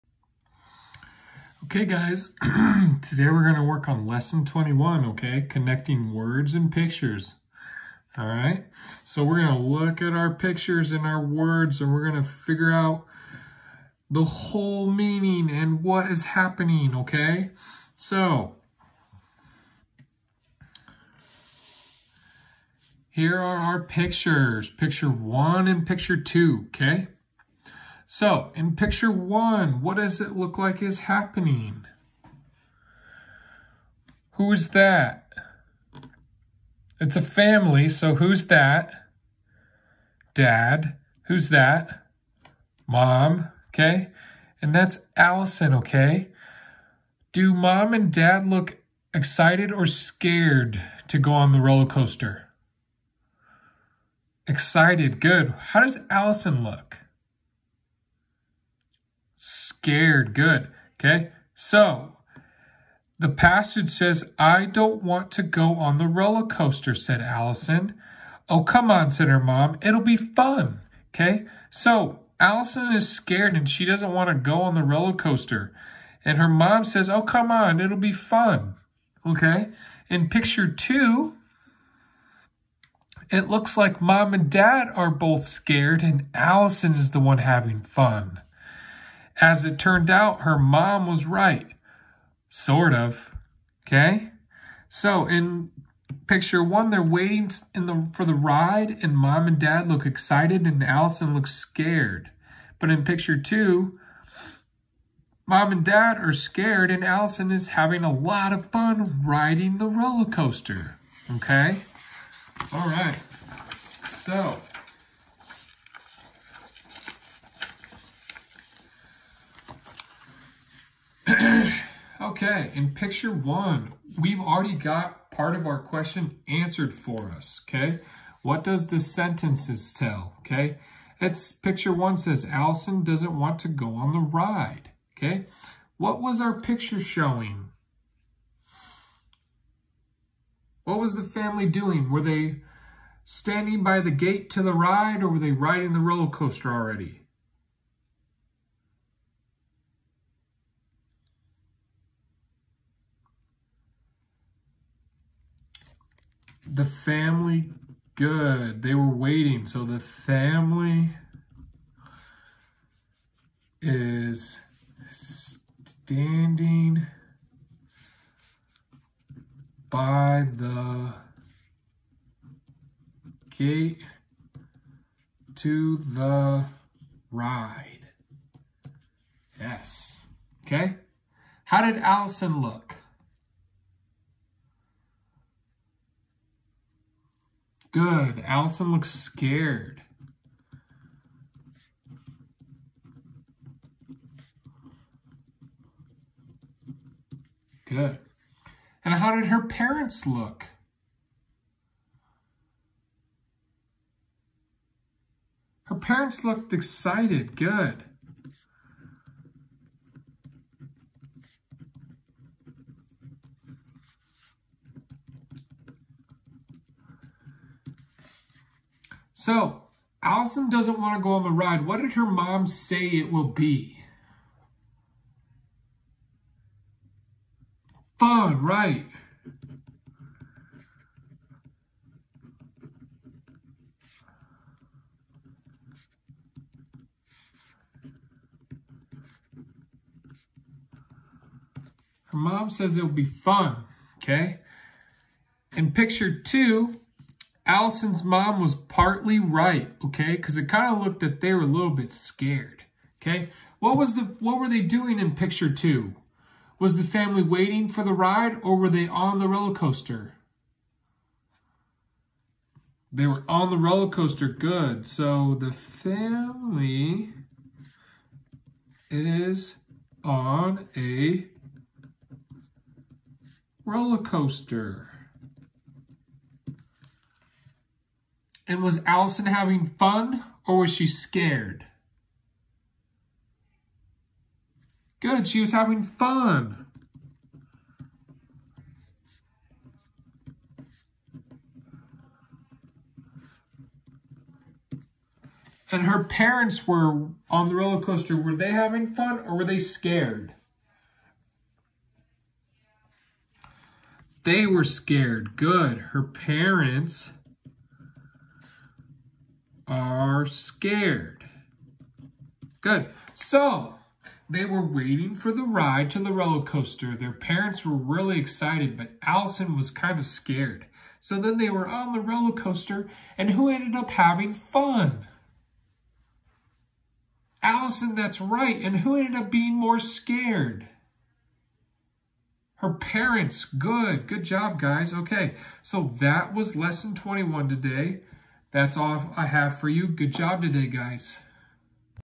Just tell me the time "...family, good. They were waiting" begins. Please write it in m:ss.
2:36.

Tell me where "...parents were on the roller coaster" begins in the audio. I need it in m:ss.
4:56.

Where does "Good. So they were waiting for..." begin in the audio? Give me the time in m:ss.
5:12.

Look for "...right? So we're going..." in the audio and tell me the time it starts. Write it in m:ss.
0:08.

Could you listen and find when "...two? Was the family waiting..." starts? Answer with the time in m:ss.
4:15.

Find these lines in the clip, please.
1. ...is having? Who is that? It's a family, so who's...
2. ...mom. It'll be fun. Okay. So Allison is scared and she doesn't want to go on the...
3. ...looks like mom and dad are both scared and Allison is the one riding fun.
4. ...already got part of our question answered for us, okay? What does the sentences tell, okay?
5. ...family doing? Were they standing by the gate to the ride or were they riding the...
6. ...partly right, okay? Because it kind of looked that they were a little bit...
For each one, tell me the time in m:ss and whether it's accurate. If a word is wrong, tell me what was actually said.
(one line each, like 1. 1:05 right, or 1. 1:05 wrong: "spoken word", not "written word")
1. 0:30 wrong: "happening", not "having"
2. 1:09 right
3. 1:23 wrong: "having", not "riding"
4. 2:04 right
5. 2:21 right
6. 4:08 right.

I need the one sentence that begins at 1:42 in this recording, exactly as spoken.
But in picture two, mom and dad are scared, and Allison is having a lot of fun riding the roller coaster.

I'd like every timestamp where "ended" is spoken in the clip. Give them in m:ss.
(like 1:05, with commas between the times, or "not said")
5:23, 5:29.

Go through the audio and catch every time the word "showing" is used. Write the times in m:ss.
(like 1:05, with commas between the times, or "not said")
2:16.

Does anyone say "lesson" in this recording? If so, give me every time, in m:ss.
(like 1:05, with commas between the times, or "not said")
0:04, 5:36.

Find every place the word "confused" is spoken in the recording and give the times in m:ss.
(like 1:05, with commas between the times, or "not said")
not said.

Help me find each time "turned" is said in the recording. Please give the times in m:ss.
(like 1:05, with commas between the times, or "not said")
1:29.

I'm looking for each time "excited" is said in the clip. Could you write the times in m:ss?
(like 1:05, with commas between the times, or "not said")
0:49, 0:54, 1:40, 3:26, 5:18.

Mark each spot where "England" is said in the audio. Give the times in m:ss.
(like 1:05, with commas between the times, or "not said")
not said.